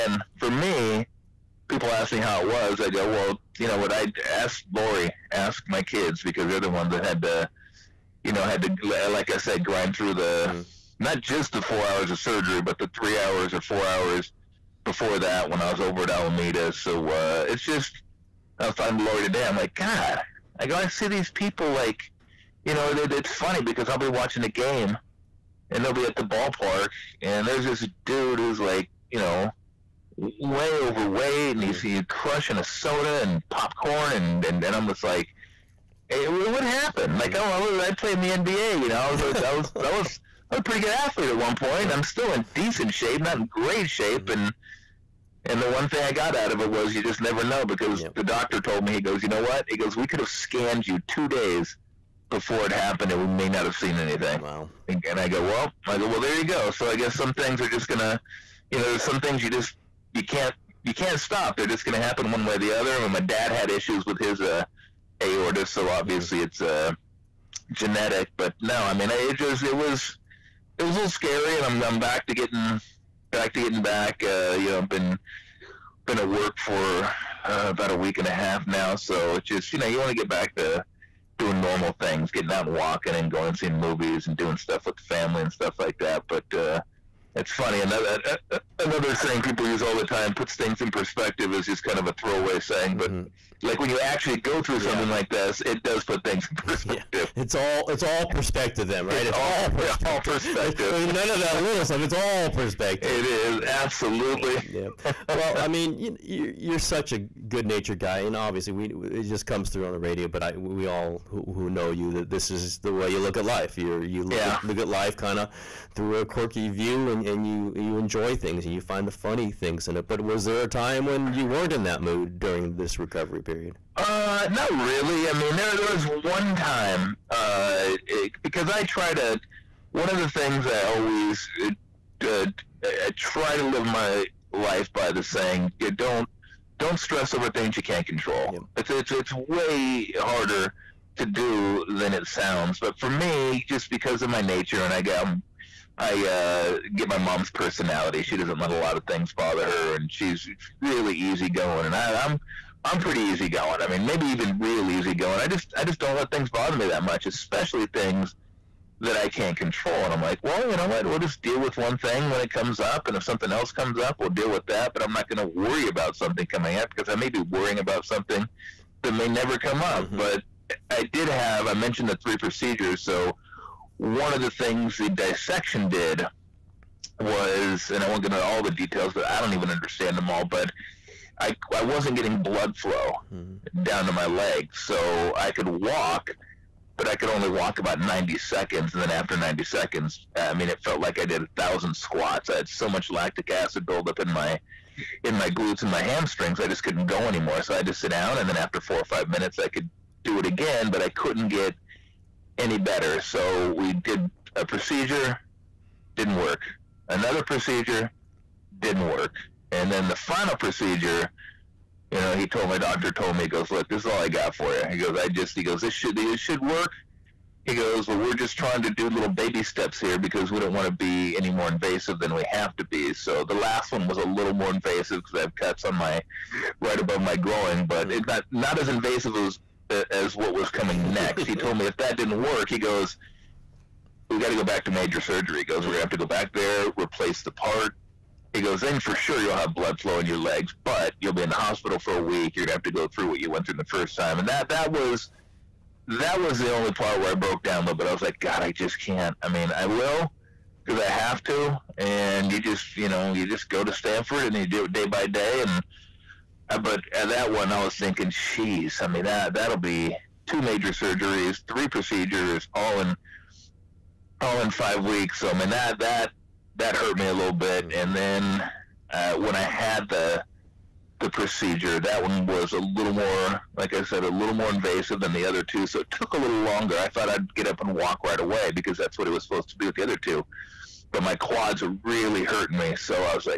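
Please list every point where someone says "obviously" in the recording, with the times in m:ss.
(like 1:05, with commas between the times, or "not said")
1:05, 1:48.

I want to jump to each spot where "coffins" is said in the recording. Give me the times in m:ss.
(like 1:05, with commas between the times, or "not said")
not said.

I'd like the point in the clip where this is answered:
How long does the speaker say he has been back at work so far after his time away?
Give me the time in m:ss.
1:17.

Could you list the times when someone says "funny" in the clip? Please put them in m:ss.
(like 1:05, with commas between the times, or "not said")
0:23, 1:27, 1:59.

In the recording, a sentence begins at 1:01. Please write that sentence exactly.
They're just gonna happen one way or the other.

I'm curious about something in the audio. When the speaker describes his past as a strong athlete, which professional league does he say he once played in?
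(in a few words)
NBA.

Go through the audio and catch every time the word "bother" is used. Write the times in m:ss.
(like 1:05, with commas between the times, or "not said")
2:29, 2:36.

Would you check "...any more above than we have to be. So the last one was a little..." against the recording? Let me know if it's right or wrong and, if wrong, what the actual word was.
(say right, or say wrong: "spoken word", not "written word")
wrong: "invasive", not "above".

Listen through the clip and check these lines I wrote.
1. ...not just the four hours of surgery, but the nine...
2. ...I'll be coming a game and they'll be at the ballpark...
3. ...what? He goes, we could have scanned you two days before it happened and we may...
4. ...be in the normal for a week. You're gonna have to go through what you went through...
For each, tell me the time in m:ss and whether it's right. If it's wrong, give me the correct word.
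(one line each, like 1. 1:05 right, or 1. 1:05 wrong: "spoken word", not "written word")
1. 0:11 wrong: "three", not "nine"
2. 0:23 wrong: "watching", not "coming"
3. 0:49 right
4. 4:01 wrong: "hospital", not "normal".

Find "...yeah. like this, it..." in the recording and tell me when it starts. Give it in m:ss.
1:35.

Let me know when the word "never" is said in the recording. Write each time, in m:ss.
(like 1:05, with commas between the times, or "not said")
0:47, 2:49.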